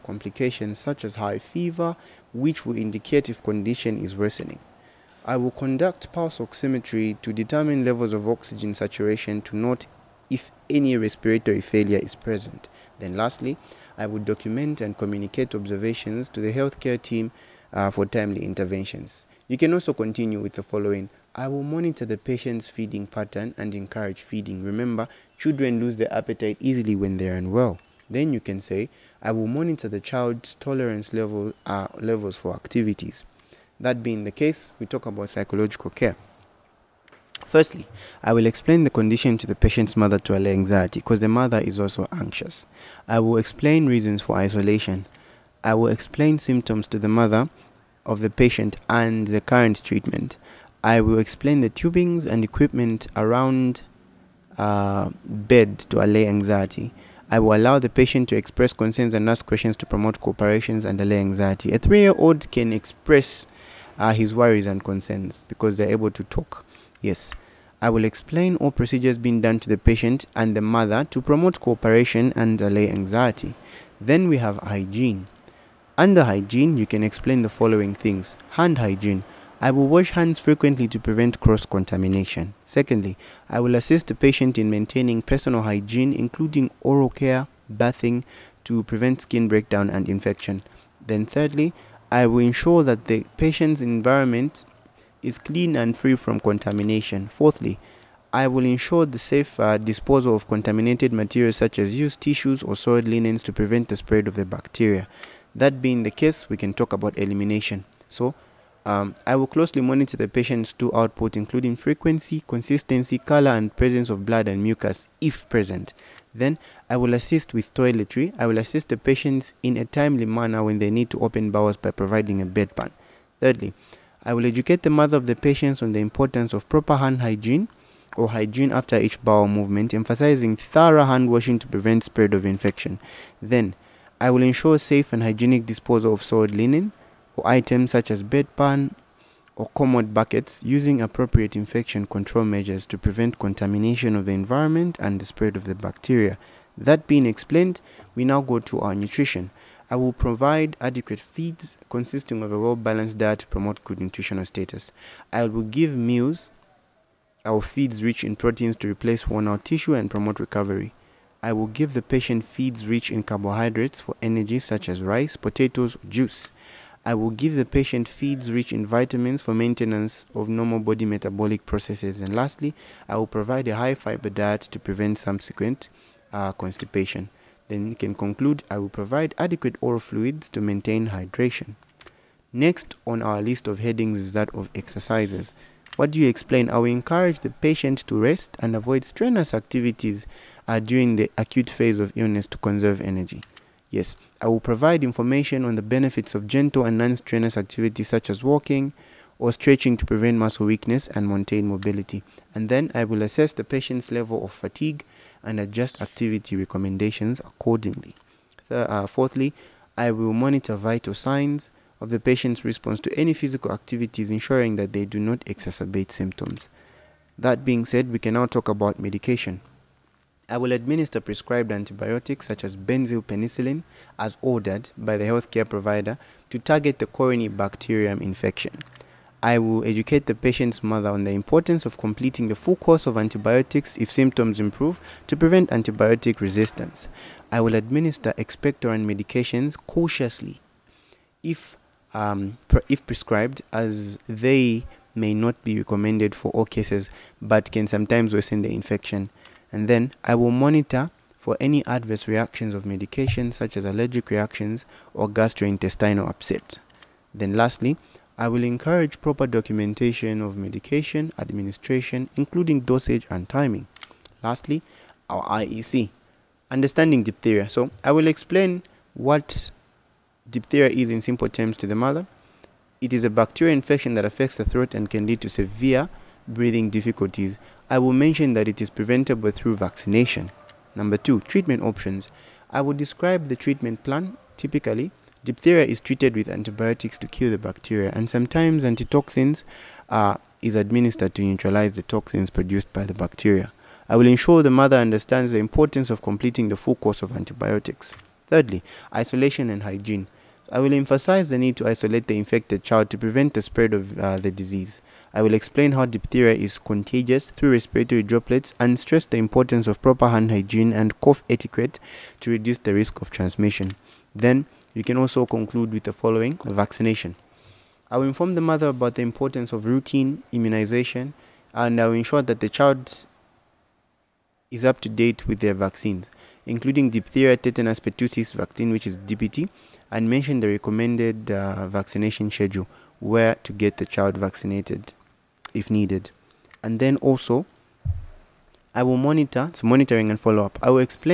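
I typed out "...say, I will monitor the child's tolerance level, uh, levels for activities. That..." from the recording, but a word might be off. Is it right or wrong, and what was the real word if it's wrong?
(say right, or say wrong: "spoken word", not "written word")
right.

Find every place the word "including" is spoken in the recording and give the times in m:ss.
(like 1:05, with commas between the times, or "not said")
1:26, 1:51, 4:22, 5:26.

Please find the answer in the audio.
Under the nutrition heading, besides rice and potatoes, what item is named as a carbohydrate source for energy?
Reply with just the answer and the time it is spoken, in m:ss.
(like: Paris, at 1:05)
Juice, at 2:46.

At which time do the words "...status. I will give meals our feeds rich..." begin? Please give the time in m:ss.
2:34.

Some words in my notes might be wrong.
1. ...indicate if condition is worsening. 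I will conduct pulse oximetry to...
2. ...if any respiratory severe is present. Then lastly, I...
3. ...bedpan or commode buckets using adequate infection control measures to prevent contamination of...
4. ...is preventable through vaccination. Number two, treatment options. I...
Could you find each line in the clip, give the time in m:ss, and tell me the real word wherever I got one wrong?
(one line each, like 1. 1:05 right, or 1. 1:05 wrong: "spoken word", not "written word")
1. 0:02 right
2. 0:10 wrong: "failure", not "severe"
3. 2:18 wrong: "appropriate", not "adequate"
4. 4:38 right.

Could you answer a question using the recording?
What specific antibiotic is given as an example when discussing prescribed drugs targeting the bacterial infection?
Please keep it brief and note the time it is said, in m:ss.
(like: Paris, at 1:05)
Benzyl penicillin, at 3:42.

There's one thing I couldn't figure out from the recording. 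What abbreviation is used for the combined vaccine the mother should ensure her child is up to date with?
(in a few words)
DPT.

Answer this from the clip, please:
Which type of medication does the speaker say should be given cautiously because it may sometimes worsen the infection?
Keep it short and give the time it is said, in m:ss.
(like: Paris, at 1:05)
Expectorant, at 3:58.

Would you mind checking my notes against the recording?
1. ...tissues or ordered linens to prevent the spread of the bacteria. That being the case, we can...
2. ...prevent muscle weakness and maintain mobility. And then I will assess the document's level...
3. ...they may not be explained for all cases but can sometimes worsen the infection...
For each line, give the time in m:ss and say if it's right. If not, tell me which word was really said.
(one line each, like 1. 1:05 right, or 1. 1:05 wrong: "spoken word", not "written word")
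1. 1:42 wrong: "soiled", not "ordered"
2. 3:20 wrong: "patient", not "document"
3. 4:04 wrong: "recommended", not "explained".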